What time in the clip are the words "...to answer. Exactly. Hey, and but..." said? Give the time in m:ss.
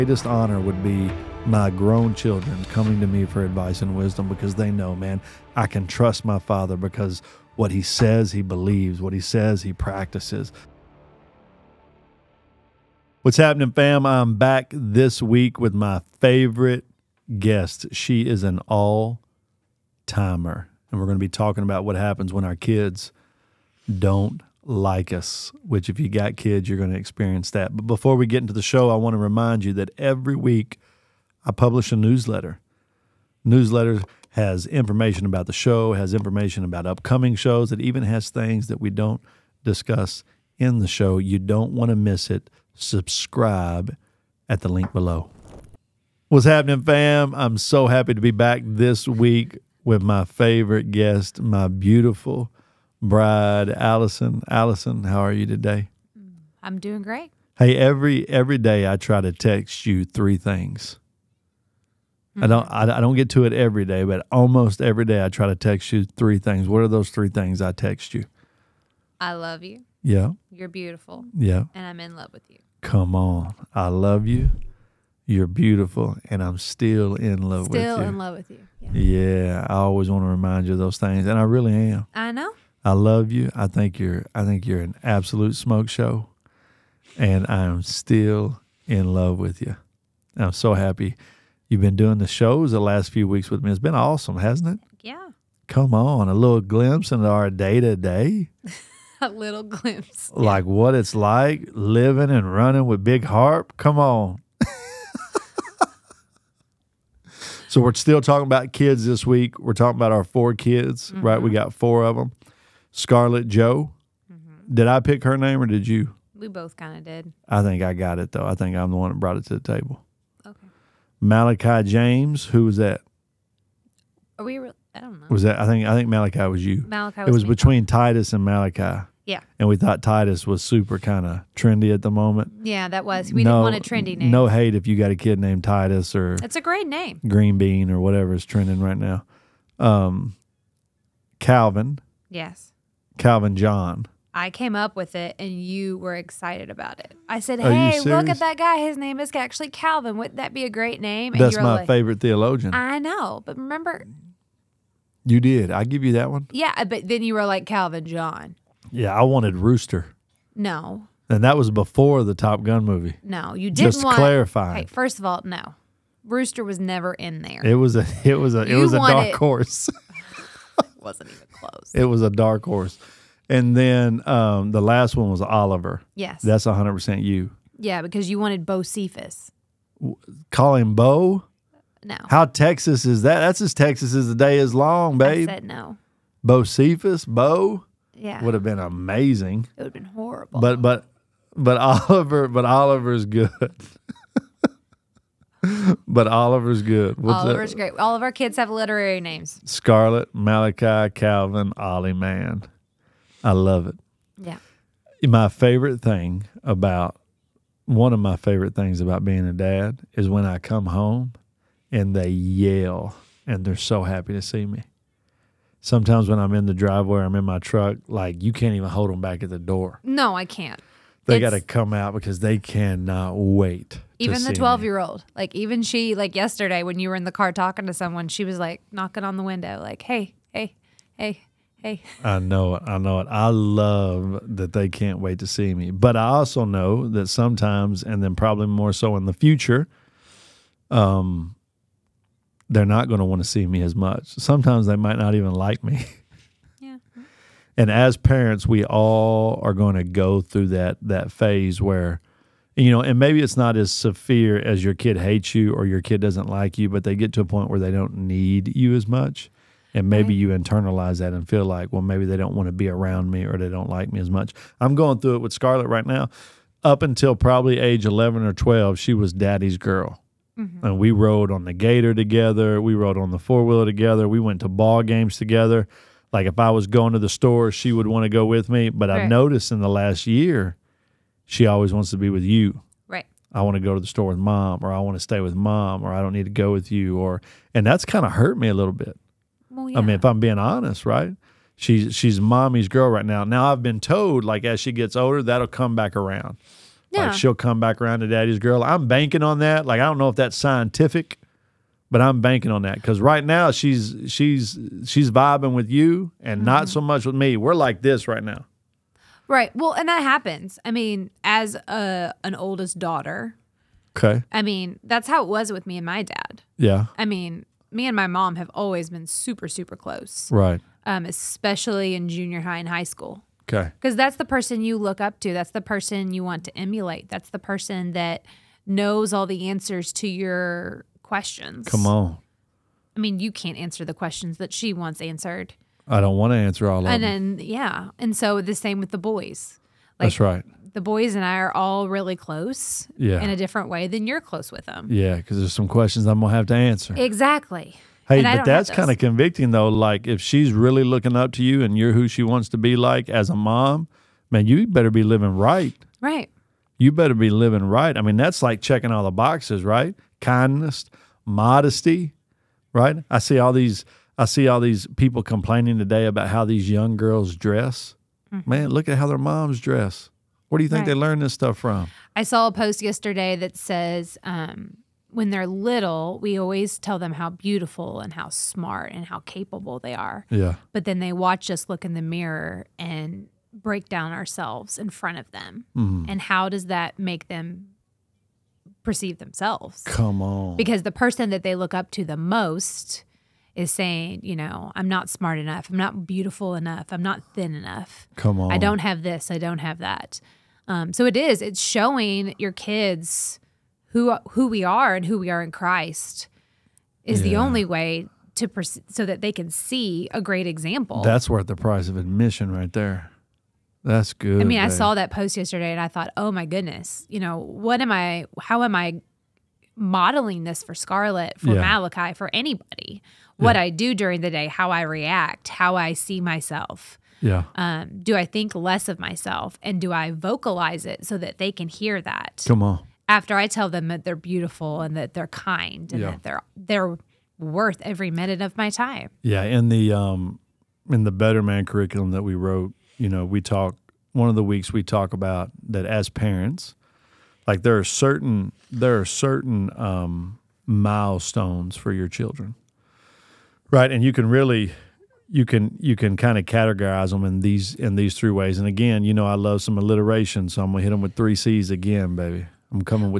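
5:46.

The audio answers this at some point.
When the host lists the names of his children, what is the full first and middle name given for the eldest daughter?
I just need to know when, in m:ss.
1:52.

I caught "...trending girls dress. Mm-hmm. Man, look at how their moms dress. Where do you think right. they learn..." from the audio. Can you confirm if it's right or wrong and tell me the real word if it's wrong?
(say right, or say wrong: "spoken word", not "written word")
wrong: "young", not "trending".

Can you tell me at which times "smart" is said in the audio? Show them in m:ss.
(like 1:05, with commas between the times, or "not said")
6:18, 6:35.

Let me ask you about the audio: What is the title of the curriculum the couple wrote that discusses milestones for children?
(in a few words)
Better Man.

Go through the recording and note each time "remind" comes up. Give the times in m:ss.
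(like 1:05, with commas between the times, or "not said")
0:29, 1:20.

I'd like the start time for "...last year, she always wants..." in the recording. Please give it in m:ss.
4:39.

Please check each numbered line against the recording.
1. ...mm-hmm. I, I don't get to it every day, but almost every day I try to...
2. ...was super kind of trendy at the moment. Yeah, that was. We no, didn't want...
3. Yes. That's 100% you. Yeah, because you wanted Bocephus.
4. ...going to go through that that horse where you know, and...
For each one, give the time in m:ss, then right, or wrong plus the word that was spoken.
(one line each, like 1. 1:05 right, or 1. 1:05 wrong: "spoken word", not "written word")
1. 1:02 right
2. 2:10 right
3. 2:56 right
4. 4:09 wrong: "phase", not "horse".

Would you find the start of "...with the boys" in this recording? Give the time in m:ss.
5:38.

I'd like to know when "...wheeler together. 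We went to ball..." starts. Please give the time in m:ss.
4:33.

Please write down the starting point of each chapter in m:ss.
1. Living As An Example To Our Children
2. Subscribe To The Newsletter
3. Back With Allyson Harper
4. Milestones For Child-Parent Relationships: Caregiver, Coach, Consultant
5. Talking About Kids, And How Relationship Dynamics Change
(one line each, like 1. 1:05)
1. 5:48
2. 0:12
3. 0:45
4. 6:57
5. 1:47.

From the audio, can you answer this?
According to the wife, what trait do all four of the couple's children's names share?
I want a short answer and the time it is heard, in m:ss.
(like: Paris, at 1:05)
Literary names, at 3:18.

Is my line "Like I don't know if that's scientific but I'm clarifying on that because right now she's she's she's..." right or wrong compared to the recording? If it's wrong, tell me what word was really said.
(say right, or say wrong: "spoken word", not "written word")
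wrong: "banking", not "clarifying".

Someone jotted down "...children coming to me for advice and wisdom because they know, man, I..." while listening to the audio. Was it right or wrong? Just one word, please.
right.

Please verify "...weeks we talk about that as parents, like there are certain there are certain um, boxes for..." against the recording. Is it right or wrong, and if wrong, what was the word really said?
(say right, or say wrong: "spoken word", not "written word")
wrong: "milestones", not "boxes".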